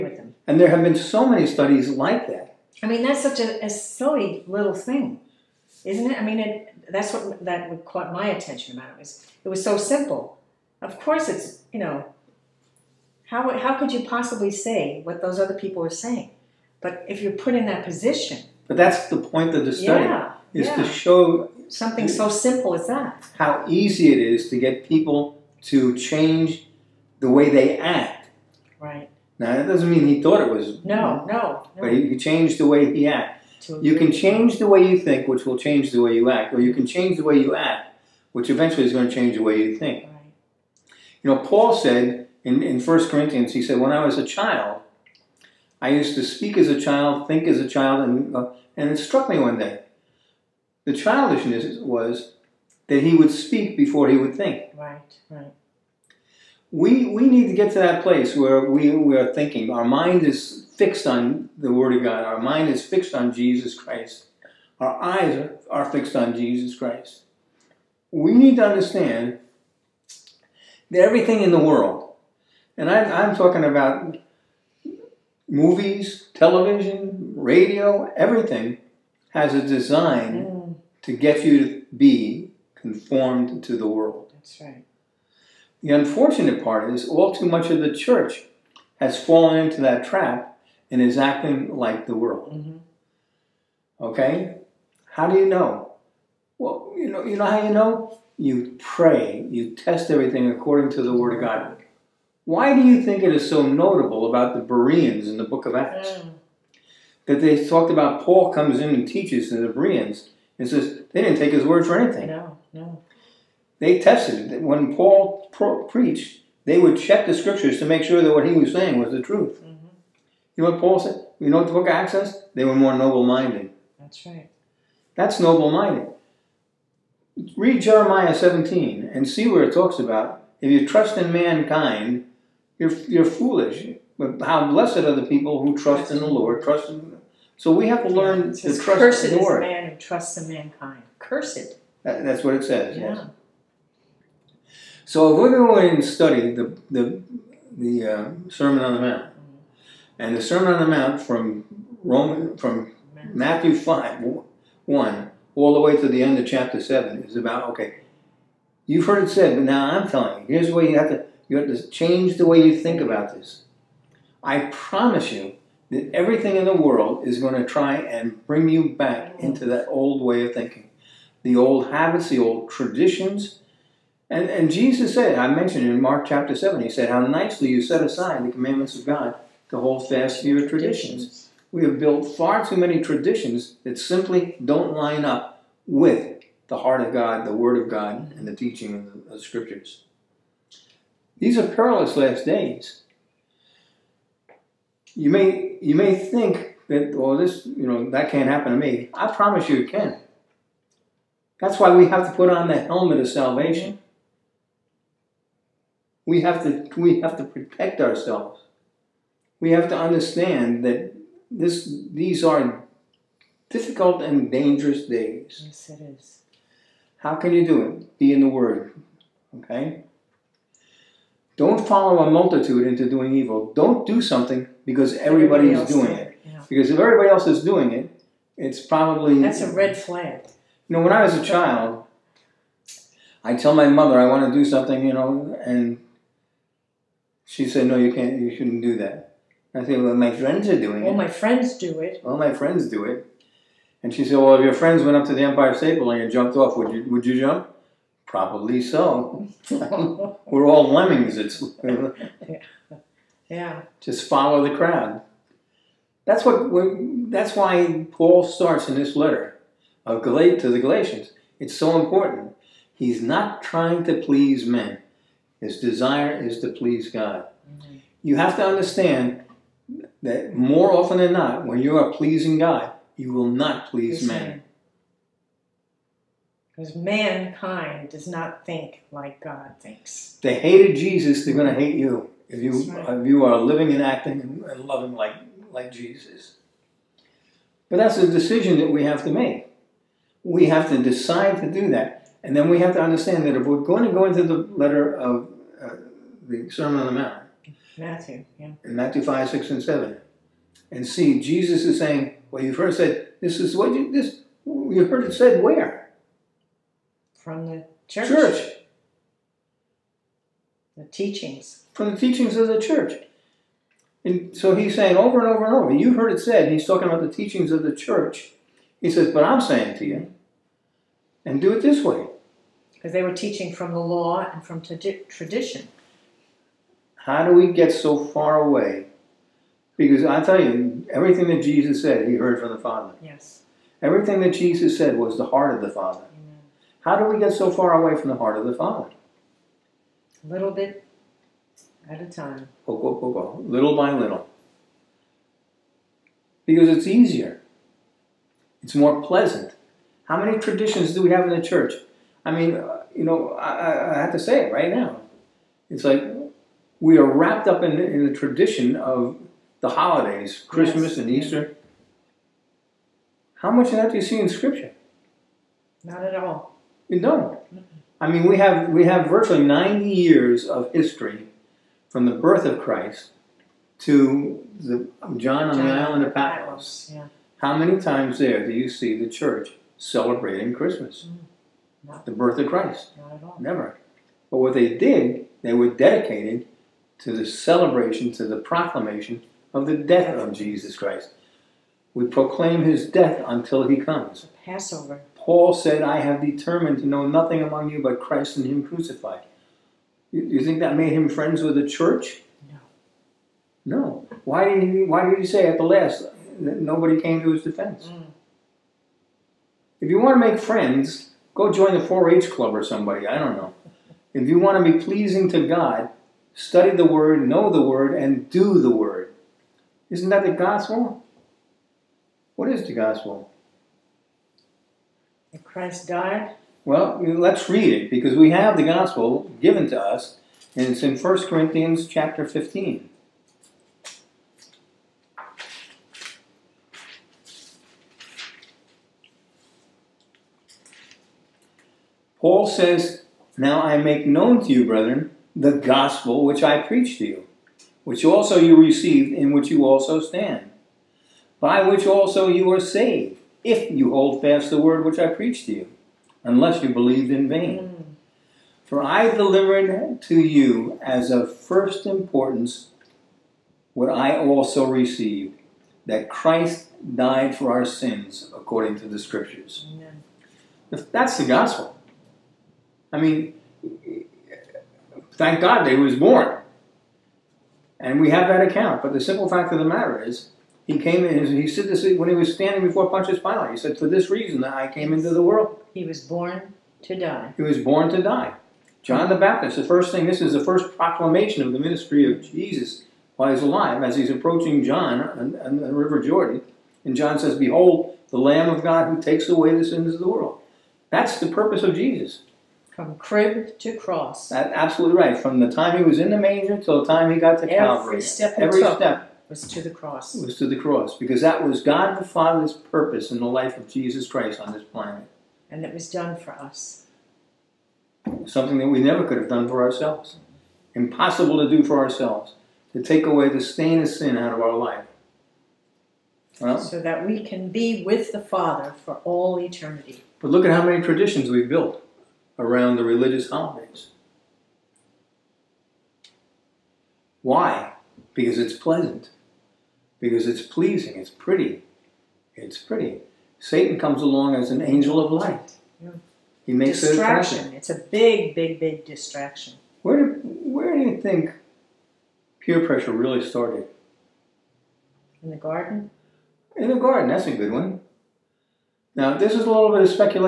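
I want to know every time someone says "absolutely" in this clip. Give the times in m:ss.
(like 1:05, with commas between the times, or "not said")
8:24.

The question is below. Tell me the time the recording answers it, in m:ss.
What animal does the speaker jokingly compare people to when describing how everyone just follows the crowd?
4:10.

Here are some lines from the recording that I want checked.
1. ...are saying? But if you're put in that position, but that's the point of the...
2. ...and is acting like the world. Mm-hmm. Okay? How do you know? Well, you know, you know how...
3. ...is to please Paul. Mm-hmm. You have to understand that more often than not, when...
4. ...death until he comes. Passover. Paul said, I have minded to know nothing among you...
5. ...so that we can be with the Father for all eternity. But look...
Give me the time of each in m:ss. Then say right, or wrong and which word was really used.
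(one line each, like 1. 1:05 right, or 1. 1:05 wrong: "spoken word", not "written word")
1. 0:15 right
2. 1:30 right
3. 4:26 wrong: "God", not "Paul"
4. 6:33 wrong: "determined", not "minded"
5. 8:46 right.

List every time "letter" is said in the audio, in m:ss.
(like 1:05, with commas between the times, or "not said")
4:19, 4:54.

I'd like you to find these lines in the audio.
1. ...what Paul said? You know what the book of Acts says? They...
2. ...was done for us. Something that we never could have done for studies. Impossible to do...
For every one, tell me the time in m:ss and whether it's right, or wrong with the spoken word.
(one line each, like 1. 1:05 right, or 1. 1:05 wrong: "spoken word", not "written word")
1. 2:00 right
2. 8:35 wrong: "ourselves", not "studies".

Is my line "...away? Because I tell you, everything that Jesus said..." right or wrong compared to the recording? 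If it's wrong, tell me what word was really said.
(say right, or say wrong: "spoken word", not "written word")
right.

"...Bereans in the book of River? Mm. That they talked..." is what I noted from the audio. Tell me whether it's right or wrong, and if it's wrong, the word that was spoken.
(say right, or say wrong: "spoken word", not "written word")
wrong: "Acts", not "River".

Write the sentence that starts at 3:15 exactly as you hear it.
You may, you may think that, well, this, you know, that can't happen to me.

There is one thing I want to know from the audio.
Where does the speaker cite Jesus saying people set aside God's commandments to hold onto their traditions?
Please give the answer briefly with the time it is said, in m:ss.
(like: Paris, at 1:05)
Mark chapter 7, at 2:56.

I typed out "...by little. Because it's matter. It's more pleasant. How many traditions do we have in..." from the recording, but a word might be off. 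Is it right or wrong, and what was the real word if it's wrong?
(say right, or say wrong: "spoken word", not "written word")
wrong: "easier", not "matter".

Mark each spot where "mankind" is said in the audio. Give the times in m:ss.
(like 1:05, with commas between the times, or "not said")
2:11, 2:20, 4:36.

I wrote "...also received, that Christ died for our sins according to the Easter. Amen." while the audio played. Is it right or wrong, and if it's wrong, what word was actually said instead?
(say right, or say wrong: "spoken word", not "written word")
wrong: "Scriptures", not "Easter".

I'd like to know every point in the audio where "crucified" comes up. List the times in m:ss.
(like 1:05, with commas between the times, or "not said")
6:38.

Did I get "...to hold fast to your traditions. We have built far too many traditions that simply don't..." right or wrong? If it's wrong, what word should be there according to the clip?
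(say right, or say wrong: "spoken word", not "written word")
right.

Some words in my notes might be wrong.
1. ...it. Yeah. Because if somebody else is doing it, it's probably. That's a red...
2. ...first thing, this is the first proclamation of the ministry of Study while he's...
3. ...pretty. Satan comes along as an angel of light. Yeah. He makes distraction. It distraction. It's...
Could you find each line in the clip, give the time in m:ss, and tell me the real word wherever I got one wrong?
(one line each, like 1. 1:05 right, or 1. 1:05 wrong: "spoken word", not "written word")
1. 3:46 wrong: "everybody", not "somebody"
2. 8:09 wrong: "Jesus", not "Study"
3. 9:02 right.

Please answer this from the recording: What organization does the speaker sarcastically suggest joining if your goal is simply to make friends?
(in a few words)
4 H club.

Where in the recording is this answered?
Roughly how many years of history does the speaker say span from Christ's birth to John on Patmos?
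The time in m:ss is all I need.
6:09.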